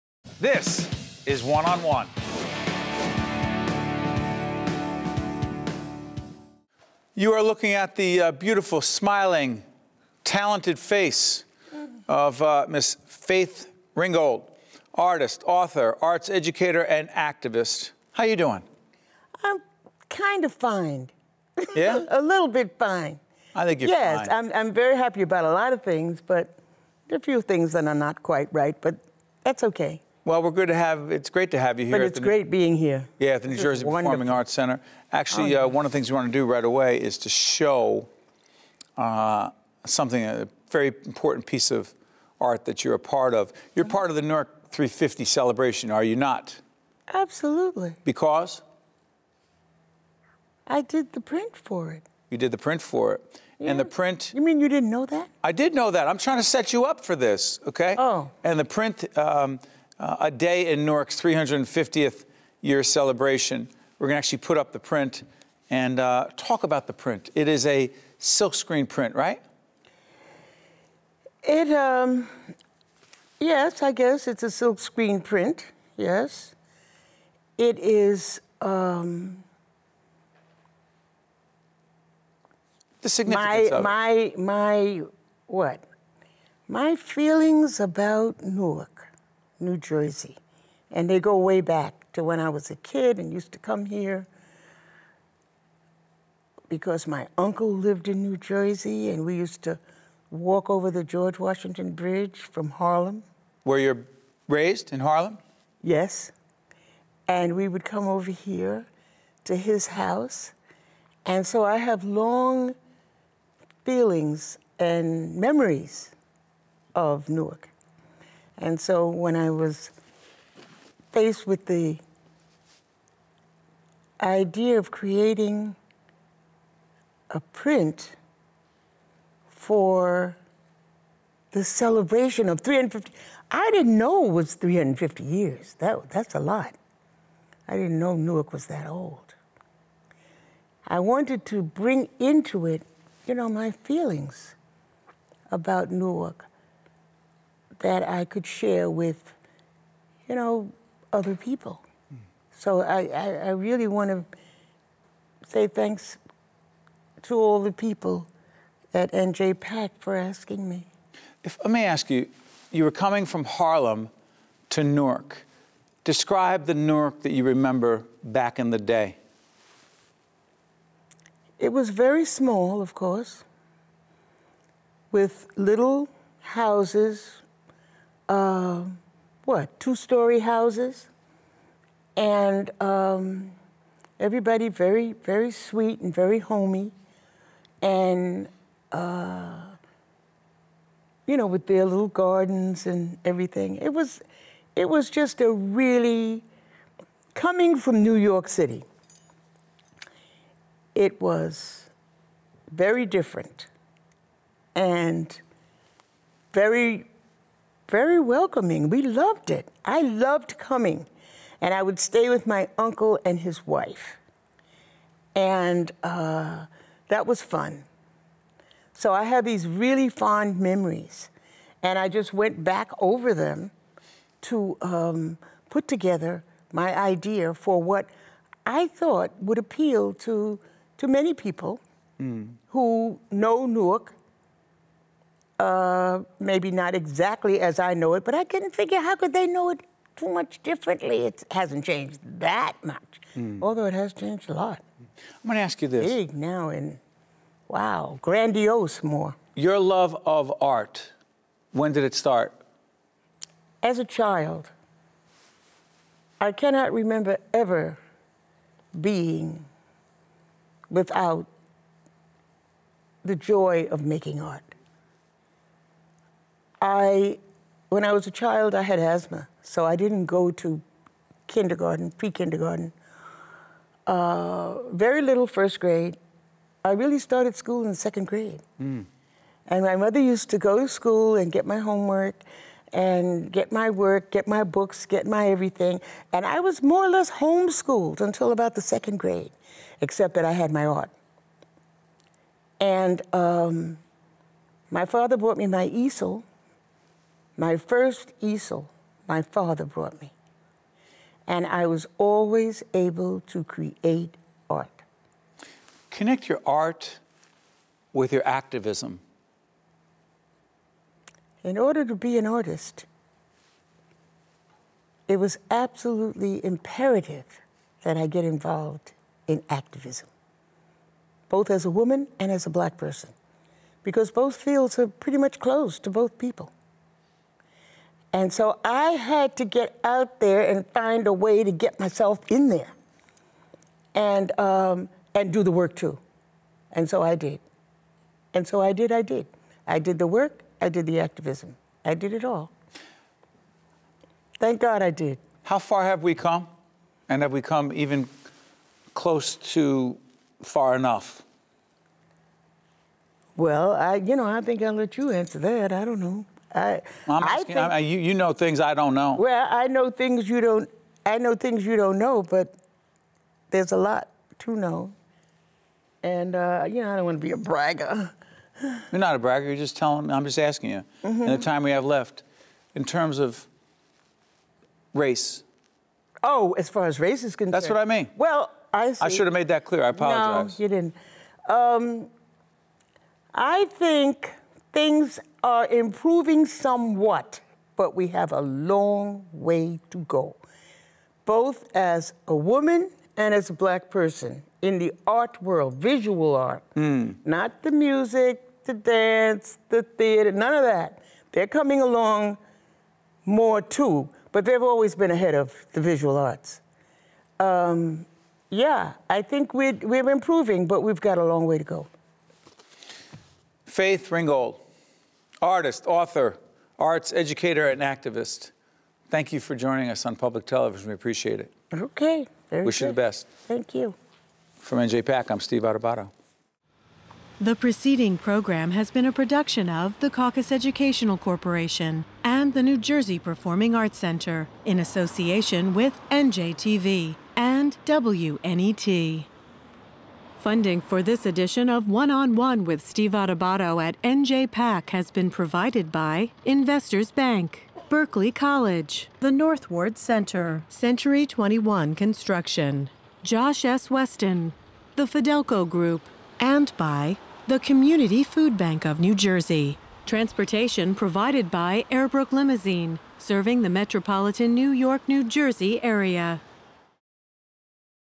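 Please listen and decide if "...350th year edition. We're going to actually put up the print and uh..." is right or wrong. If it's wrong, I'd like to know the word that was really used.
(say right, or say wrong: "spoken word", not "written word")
wrong: "celebration", not "edition".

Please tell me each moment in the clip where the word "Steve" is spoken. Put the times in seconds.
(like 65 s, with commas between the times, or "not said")
425 s, 443 s.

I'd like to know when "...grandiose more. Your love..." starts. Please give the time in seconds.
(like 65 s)
248 s.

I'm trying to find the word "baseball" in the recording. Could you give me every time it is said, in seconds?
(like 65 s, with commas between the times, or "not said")
not said.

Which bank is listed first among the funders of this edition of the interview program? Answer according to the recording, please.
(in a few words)
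Investors Bank.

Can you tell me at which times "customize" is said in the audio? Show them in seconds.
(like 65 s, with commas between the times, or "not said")
not said.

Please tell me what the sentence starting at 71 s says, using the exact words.
It, um, yes, I guess it's a silkscreen print, yes.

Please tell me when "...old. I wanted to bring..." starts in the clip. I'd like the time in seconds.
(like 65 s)
138 s.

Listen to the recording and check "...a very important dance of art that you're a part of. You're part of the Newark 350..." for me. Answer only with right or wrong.
wrong.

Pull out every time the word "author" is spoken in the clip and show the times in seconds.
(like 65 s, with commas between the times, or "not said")
15 s, 416 s.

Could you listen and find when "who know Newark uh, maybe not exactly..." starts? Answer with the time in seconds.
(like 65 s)
232 s.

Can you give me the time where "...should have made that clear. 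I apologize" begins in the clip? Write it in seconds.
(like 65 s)
379 s.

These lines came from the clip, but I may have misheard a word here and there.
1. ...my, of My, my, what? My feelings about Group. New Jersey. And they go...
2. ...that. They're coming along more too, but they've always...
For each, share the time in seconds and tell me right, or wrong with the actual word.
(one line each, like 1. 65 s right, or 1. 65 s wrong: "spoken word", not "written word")
1. 83 s wrong: "Newark", not "Group"
2. 400 s right.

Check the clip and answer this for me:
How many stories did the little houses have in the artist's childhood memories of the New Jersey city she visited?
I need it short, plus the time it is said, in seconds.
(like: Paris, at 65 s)
2, at 179 s.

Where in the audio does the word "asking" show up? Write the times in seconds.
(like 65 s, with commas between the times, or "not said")
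160 s, 357 s, 370 s.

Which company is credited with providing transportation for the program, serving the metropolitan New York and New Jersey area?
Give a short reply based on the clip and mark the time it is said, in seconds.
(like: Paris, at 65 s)
Airbrook Limousine, at 462 s.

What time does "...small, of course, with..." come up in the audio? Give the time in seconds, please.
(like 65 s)
172 s.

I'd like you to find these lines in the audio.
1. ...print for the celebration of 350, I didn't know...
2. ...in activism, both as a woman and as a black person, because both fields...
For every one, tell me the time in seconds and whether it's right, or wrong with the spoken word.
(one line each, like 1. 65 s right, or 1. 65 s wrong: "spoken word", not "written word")
1. 127 s right
2. 319 s right.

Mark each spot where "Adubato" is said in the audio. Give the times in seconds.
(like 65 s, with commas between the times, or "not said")
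425 s, 443 s.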